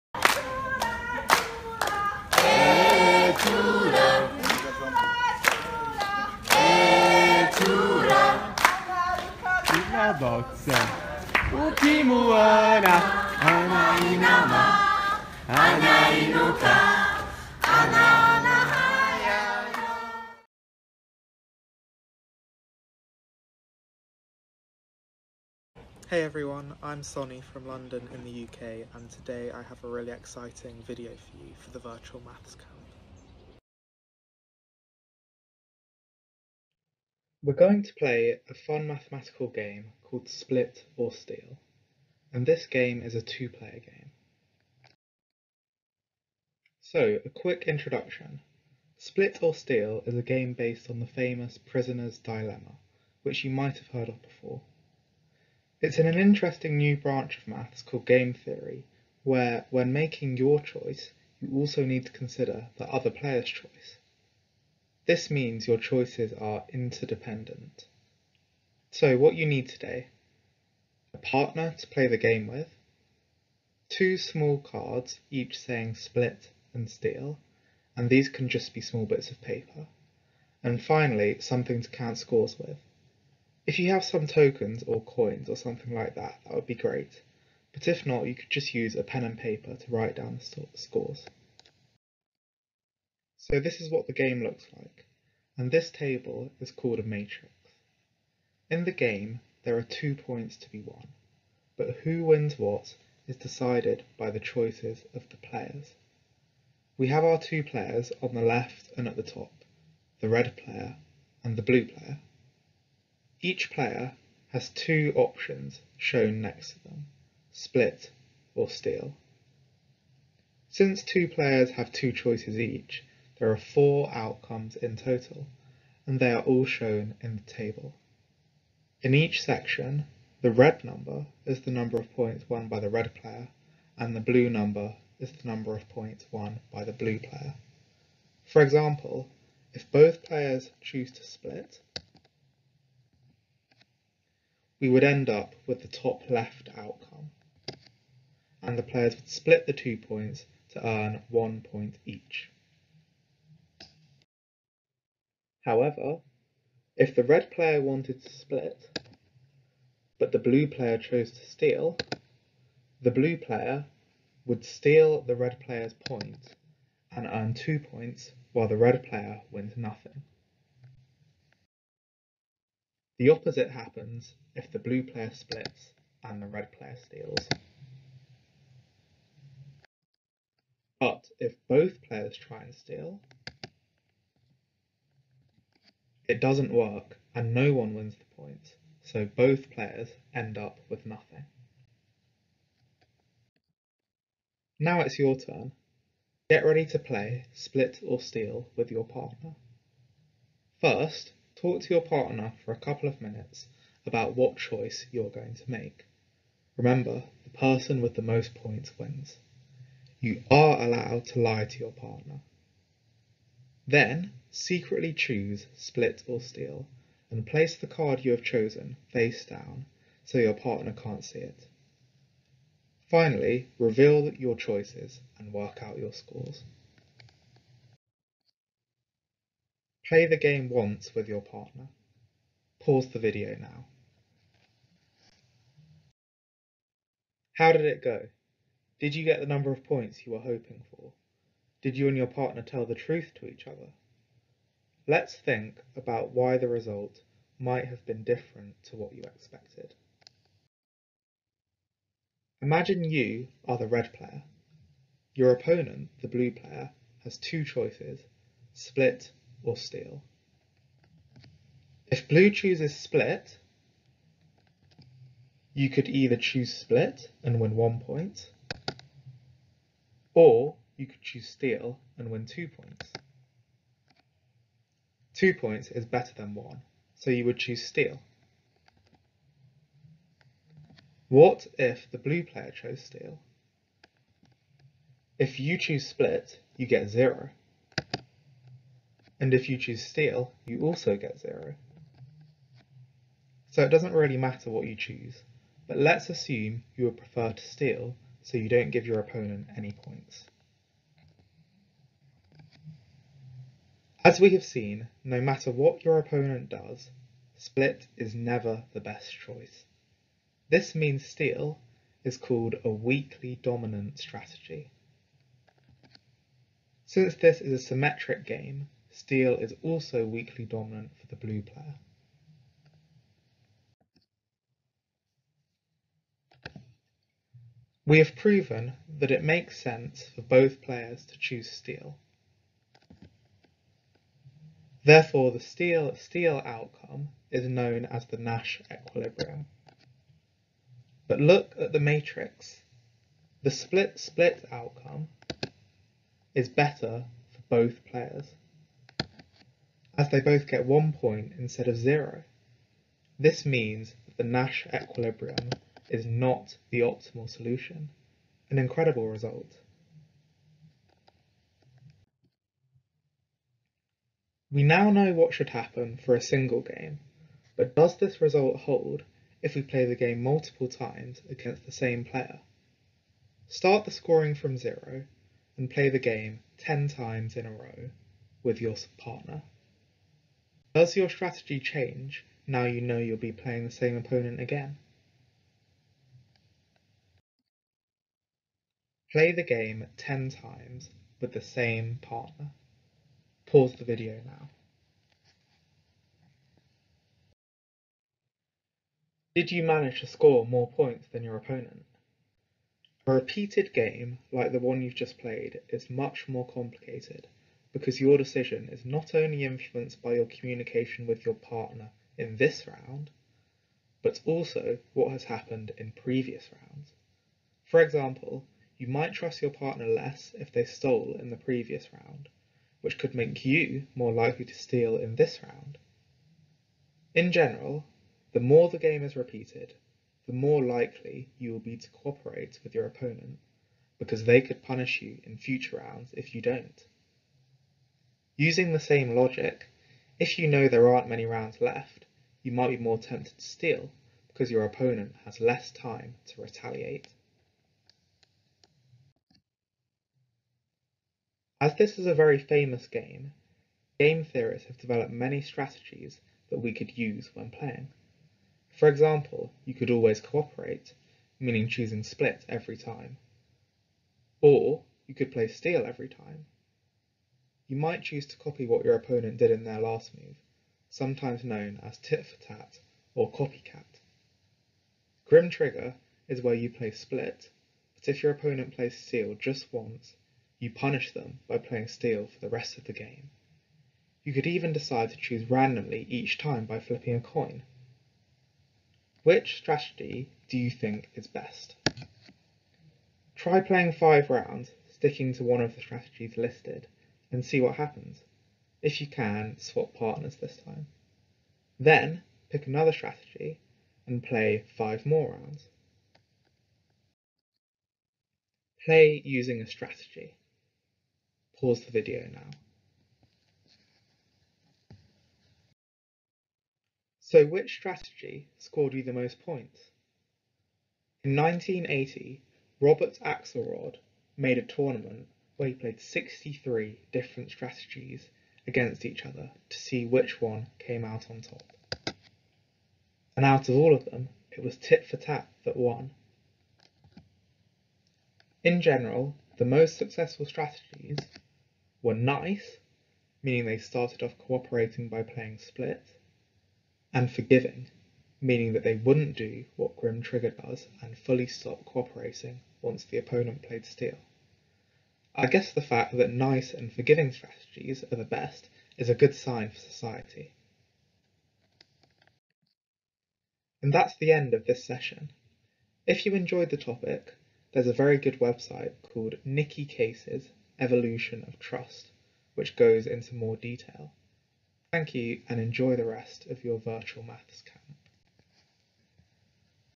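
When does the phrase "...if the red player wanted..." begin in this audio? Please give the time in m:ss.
2:36.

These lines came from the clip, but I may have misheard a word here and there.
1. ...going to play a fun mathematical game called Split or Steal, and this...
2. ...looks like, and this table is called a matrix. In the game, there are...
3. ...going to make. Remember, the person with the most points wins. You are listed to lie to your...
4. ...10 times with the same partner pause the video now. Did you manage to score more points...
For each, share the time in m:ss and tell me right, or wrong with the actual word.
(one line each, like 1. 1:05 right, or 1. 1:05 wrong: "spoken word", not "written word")
1. 0:37 right
2. 1:34 right
3. 3:25 wrong: "allowed", not "listed"
4. 6:30 right.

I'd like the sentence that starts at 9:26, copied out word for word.
If you enjoyed the topic, there's a very good website called Nicky Cases evolution of trust, which goes into more detail.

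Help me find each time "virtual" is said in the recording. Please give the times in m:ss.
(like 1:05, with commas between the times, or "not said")
0:31, 9:36.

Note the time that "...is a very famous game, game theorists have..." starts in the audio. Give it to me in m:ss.
7:32.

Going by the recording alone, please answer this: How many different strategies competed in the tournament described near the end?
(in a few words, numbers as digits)
63.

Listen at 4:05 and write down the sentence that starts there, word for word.
Let's think about why the result might have been different to what you expected.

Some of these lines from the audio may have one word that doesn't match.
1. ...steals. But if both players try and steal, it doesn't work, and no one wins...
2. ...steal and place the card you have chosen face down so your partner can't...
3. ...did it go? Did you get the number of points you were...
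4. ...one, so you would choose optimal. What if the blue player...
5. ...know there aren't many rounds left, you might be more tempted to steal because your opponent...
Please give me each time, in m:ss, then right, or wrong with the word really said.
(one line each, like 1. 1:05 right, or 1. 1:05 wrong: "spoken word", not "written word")
1. 2:57 right
2. 3:36 right
3. 3:57 right
4. 4:36 wrong: "steal", not "optimal"
5. 7:20 right.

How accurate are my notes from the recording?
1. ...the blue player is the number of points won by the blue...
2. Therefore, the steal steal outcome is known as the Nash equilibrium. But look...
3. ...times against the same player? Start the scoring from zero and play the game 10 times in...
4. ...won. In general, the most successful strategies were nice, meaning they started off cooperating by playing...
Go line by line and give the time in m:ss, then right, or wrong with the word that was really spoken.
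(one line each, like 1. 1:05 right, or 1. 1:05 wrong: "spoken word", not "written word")
1. 2:14 wrong: "number", not "player"
2. 5:35 right
3. 6:10 right
4. 8:55 right.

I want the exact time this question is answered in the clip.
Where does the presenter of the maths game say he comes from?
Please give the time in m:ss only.
0:27.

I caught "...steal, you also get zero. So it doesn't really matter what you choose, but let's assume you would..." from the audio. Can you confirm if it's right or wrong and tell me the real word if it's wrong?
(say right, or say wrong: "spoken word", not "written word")
right.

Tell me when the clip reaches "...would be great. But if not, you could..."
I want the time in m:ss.
1:26.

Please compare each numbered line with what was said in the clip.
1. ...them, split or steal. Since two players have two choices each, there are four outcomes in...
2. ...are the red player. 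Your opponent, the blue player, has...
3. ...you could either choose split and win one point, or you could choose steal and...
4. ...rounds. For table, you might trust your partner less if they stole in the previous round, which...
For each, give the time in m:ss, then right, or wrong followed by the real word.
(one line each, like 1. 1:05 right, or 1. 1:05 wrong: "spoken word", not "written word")
1. 1:56 right
2. 4:13 right
3. 4:25 right
4. 6:56 wrong: "example", not "table".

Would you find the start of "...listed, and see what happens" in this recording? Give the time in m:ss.
8:16.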